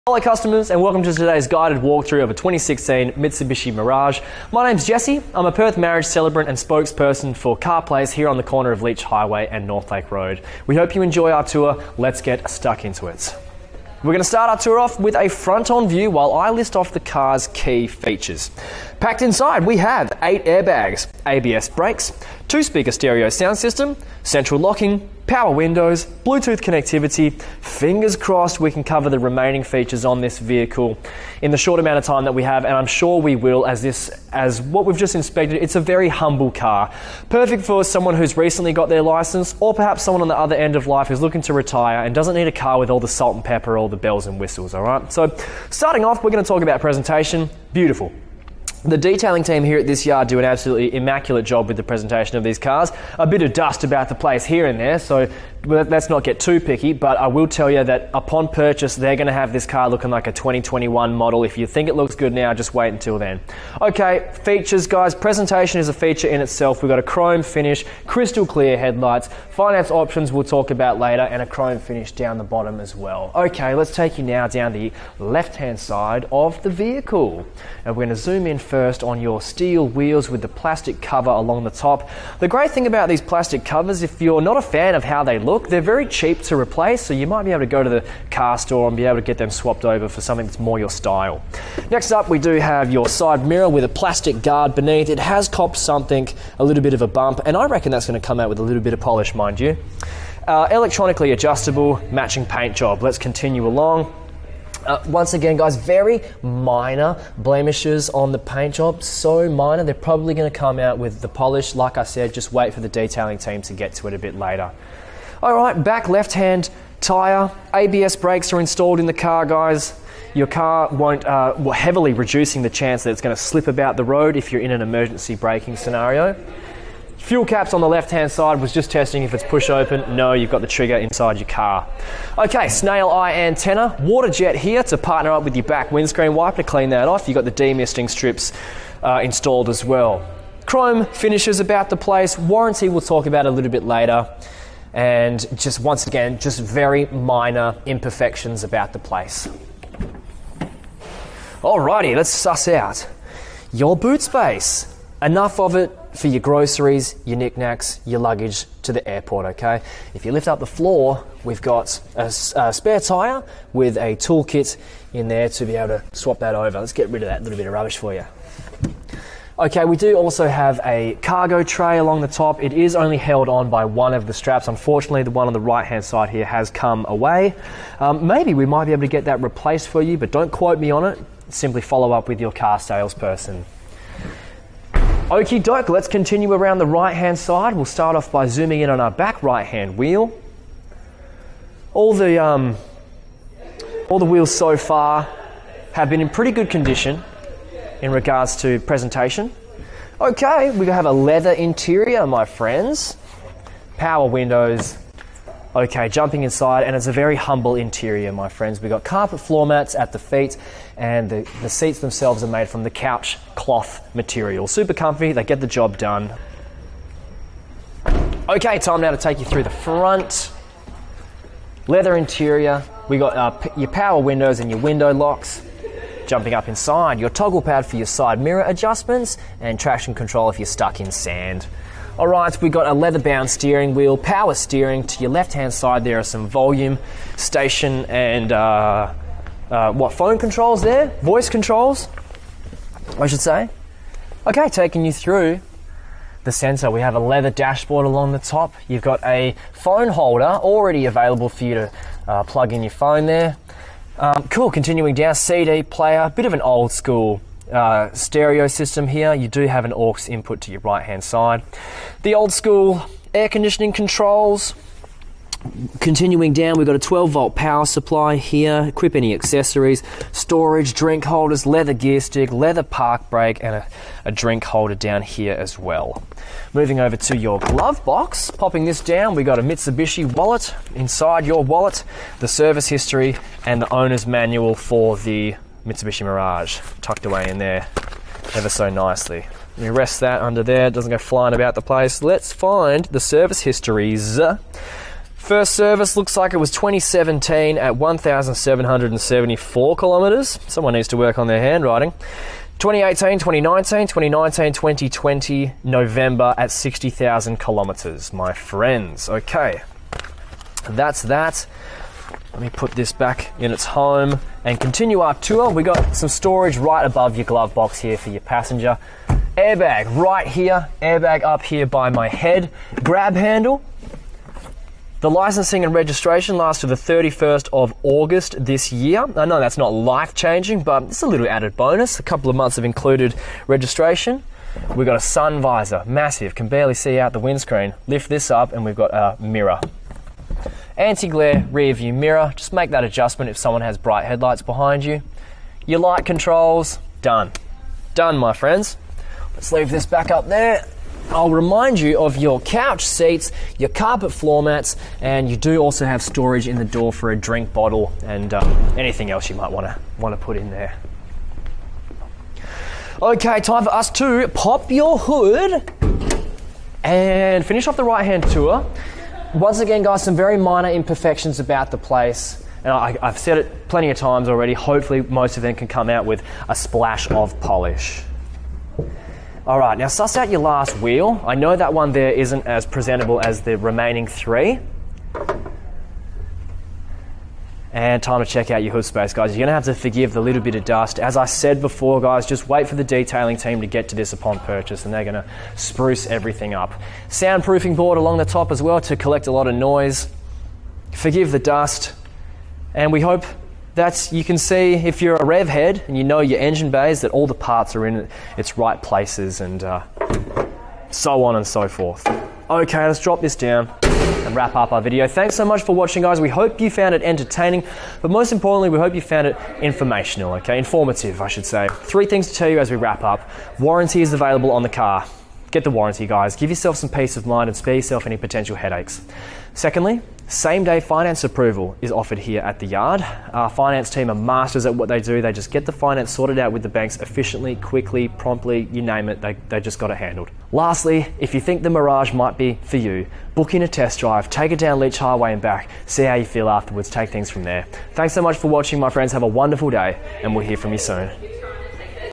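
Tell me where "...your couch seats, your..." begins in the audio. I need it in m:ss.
5:52.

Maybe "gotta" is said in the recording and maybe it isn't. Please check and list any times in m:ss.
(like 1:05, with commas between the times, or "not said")
not said.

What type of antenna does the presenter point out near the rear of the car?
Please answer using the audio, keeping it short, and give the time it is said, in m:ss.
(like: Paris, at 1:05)
snail eye antenna, at 2:12.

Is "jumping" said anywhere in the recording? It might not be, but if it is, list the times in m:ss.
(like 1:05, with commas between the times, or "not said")
3:26, 3:46.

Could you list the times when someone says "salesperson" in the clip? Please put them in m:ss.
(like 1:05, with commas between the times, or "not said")
3:02.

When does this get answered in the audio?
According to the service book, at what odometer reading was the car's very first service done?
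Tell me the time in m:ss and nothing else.
4:57.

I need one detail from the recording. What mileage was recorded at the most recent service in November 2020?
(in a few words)
60,000 kilometres.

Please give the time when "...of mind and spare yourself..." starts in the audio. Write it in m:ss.
7:07.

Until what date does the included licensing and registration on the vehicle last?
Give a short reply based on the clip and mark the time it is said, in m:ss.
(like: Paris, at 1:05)
31st of August, at 5:26.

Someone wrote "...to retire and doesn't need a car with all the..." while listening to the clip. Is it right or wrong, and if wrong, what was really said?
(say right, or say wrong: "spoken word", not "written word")
right.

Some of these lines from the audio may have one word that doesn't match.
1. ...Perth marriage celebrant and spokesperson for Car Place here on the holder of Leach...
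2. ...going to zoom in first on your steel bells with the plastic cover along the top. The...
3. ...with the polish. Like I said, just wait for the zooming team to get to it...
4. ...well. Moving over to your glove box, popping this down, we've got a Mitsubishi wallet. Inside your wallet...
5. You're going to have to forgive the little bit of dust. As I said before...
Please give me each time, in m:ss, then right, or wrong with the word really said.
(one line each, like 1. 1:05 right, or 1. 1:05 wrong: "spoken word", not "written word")
1. 0:05 wrong: "corner", not "holder"
2. 1:18 wrong: "wheels", not "bells"
3. 1:50 wrong: "detailing", not "zooming"
4. 4:35 right
5. 6:29 right.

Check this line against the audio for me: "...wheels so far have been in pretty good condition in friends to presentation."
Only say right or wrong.
wrong.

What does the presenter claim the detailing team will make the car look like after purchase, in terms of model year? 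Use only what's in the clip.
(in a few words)
a 2021 model.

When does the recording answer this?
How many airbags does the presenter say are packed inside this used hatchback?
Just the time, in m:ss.
0:20.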